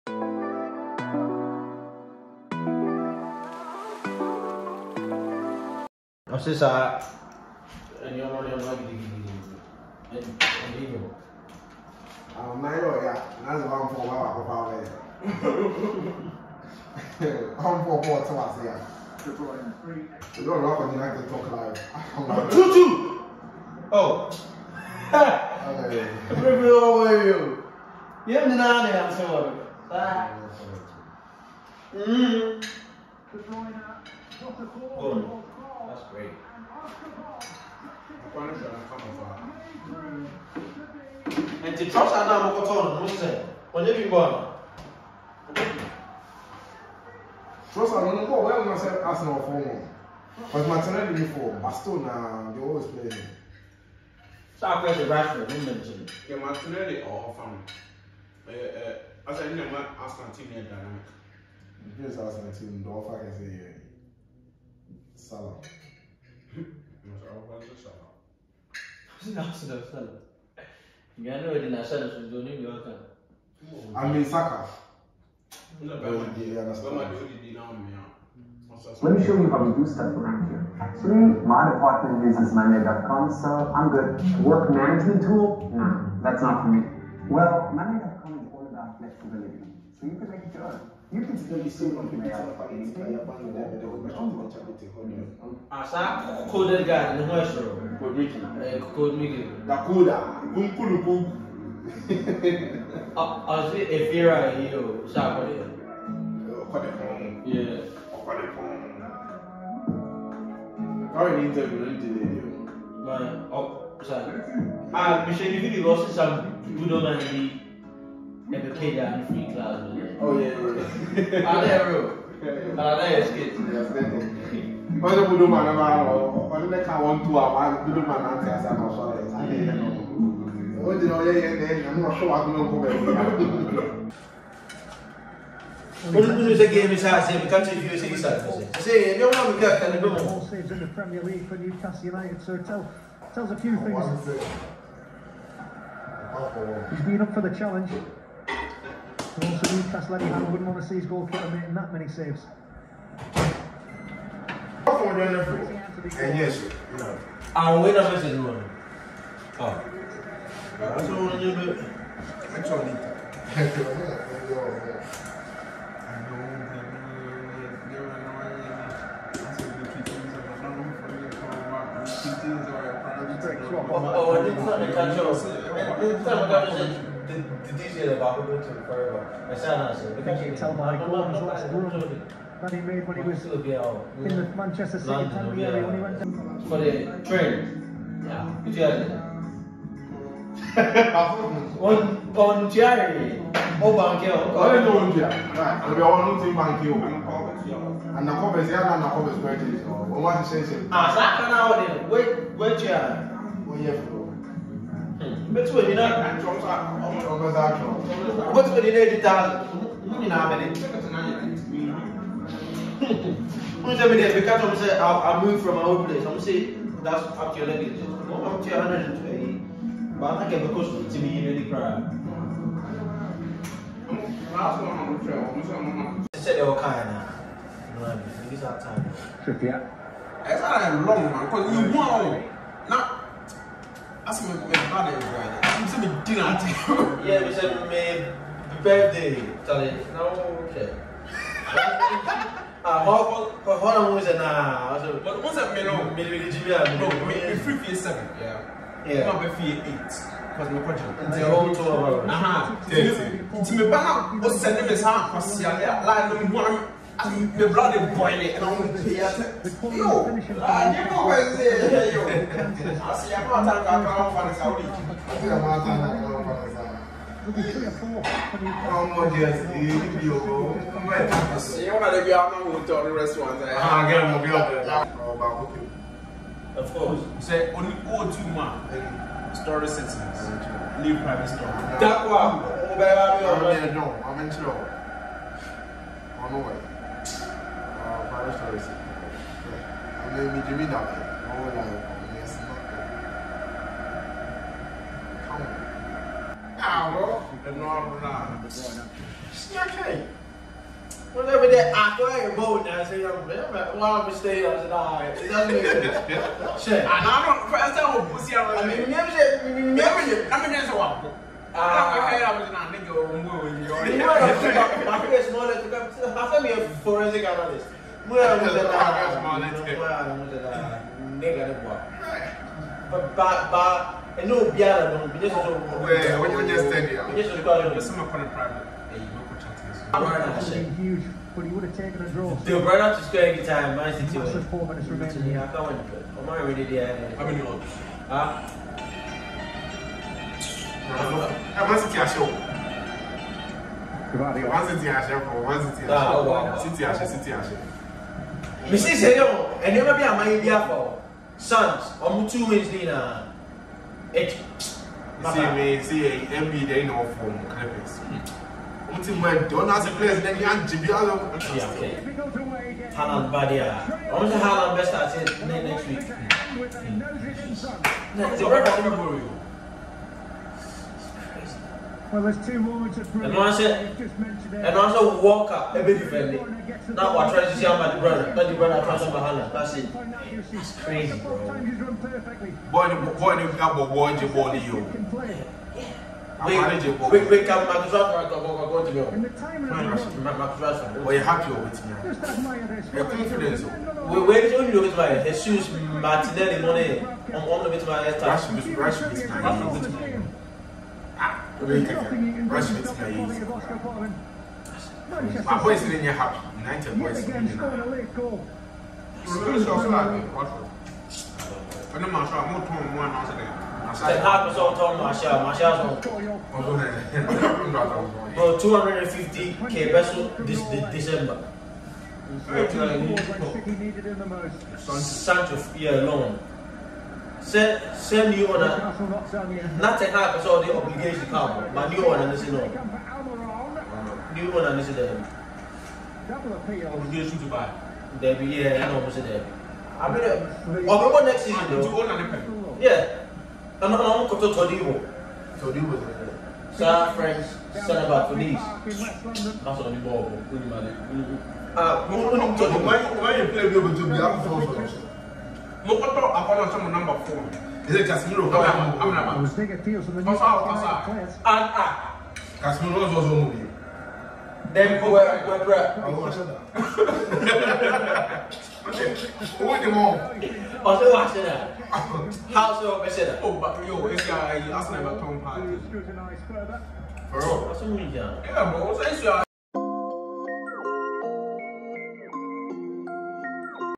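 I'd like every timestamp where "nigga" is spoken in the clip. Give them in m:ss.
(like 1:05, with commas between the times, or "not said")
5:12, 5:21.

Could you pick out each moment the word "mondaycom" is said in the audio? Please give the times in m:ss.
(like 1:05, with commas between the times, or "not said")
1:22, 1:27.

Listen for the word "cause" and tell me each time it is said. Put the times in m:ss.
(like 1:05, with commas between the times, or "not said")
3:51, 4:10, 4:15.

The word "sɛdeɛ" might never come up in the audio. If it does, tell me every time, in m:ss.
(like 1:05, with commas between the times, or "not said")
3:46.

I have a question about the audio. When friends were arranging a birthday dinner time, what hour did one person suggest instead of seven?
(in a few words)
8.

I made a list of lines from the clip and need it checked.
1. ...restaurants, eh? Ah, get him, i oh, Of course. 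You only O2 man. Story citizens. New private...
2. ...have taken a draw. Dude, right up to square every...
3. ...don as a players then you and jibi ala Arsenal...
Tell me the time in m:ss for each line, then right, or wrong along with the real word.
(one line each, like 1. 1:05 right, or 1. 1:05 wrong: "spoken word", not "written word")
1. 4:33 right
2. 5:31 right
3. 5:59 wrong: "Haaland", not "Arsenal".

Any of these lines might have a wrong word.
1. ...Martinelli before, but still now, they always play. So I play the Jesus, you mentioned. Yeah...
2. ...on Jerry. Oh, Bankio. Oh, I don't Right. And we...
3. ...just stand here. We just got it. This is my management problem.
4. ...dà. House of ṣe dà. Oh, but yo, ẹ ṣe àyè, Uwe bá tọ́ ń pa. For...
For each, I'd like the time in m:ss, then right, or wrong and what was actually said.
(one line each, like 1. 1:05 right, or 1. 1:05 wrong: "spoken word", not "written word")
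1. 0:50 wrong: "Rashford", not "Jesus"
2. 3:12 right
3. 5:26 wrong: "current", not "management"
4. 7:51 wrong: "Arsenal", not "Uwe".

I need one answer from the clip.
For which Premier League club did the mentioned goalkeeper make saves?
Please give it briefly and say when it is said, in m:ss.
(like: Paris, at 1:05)
Newcastle United, at 2:21.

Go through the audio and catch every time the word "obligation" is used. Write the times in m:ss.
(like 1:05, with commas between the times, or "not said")
7:10, 7:17.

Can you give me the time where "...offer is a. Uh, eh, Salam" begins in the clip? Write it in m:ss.
1:02.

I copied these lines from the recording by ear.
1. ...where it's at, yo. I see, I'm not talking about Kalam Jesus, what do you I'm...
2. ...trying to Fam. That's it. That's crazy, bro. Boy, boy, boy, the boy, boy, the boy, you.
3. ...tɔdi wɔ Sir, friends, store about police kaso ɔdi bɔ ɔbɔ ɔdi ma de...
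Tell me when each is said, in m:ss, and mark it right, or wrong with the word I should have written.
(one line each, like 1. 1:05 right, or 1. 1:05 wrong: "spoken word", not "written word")
1. 4:21 wrong: "Fanasa", not "Jesus"
2. 6:19 wrong: "Mahala", not "Fam"
3. 7:25 wrong: "centre", not "store".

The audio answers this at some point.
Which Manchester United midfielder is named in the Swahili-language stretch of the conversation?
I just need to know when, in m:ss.
7:38.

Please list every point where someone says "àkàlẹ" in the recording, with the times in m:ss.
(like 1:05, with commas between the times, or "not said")
2:19.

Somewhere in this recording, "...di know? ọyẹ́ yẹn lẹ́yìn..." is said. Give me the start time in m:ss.
2:10.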